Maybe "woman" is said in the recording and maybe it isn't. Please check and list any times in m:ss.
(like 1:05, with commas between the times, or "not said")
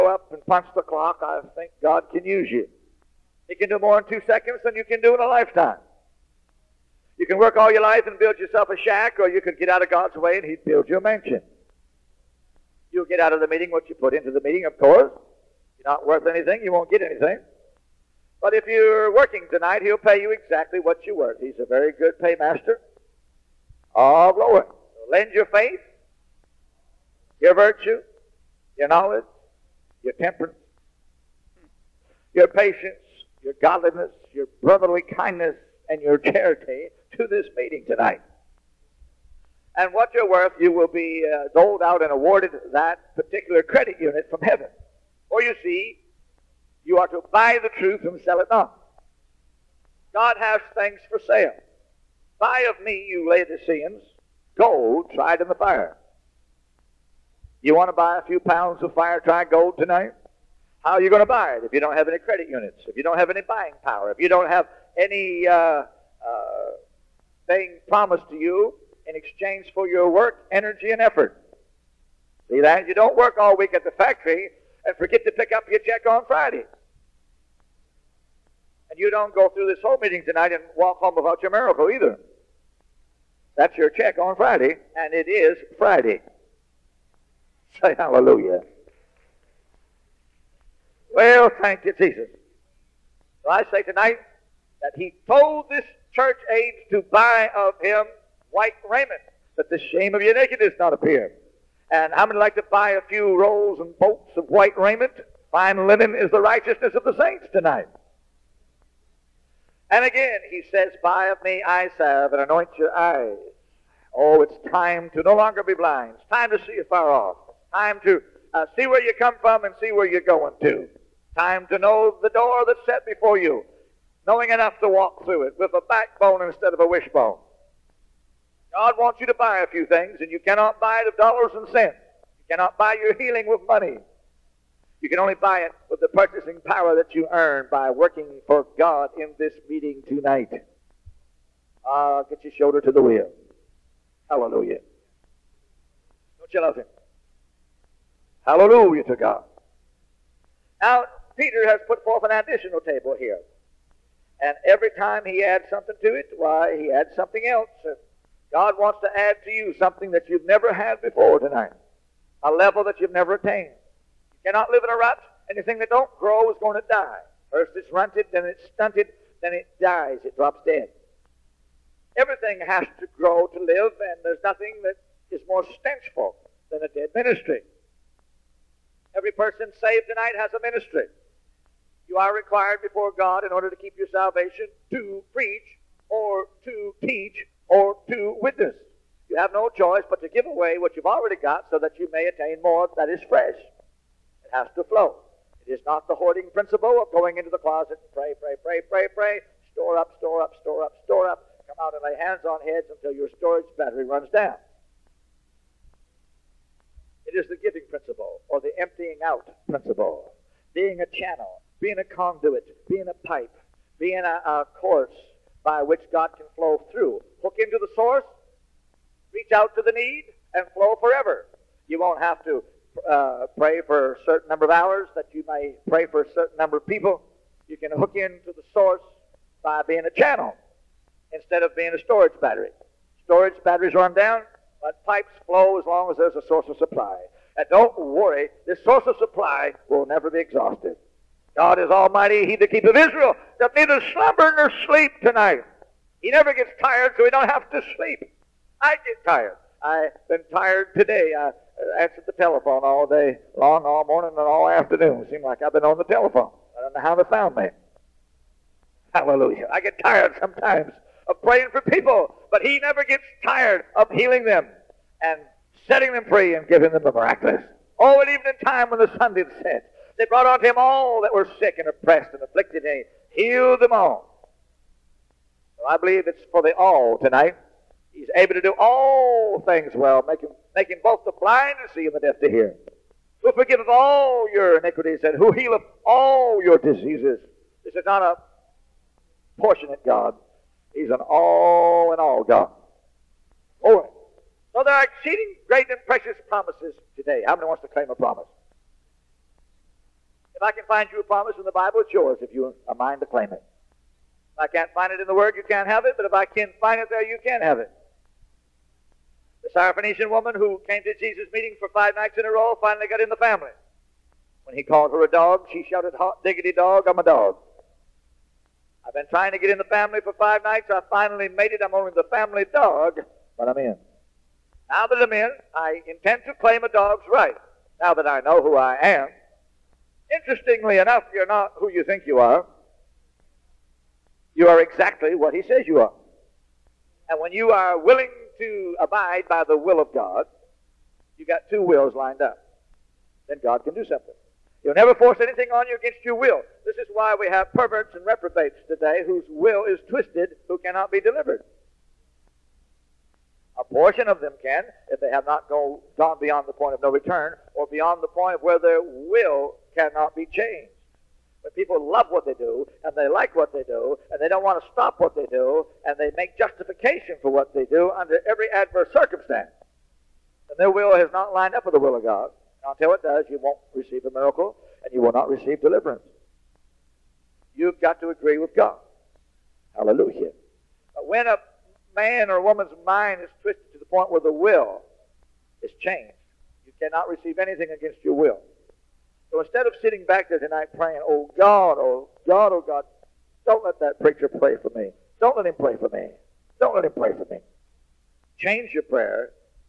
5:10, 6:22.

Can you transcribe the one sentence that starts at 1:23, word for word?
That's your check on Friday, and it is Friday.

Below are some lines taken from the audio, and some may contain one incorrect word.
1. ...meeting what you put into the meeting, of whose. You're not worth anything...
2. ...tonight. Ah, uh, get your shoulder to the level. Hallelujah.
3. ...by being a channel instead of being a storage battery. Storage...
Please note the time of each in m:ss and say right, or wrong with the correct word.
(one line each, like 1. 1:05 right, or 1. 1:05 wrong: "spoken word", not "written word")
1. 0:13 wrong: "course", not "whose"
2. 2:20 wrong: "wheel", not "level"
3. 3:49 right.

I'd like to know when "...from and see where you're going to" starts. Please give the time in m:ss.
1:59.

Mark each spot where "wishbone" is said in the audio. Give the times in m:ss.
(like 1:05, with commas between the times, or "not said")
2:06.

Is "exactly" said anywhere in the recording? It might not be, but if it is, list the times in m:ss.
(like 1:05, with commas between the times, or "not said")
0:20, 5:34.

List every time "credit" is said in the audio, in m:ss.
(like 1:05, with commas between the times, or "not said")
0:43, 1:02.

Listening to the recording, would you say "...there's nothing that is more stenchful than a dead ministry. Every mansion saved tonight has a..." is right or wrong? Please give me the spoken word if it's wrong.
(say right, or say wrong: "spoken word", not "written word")
wrong: "person", not "mansion".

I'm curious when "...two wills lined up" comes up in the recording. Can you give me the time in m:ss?
5:41.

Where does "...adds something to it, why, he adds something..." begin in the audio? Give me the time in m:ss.
2:35.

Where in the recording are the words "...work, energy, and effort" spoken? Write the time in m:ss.
1:10.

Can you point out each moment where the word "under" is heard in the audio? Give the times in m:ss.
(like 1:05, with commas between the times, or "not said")
6:08.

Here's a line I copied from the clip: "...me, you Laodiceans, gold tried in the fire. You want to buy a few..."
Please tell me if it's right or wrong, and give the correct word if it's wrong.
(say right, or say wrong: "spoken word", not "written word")
right.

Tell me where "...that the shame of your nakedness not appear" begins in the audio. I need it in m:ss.
1:39.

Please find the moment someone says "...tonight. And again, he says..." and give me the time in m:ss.
1:47.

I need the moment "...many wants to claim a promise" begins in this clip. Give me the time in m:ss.
4:57.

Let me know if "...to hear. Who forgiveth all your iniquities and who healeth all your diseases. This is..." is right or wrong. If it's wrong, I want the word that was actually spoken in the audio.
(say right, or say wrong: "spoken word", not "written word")
right.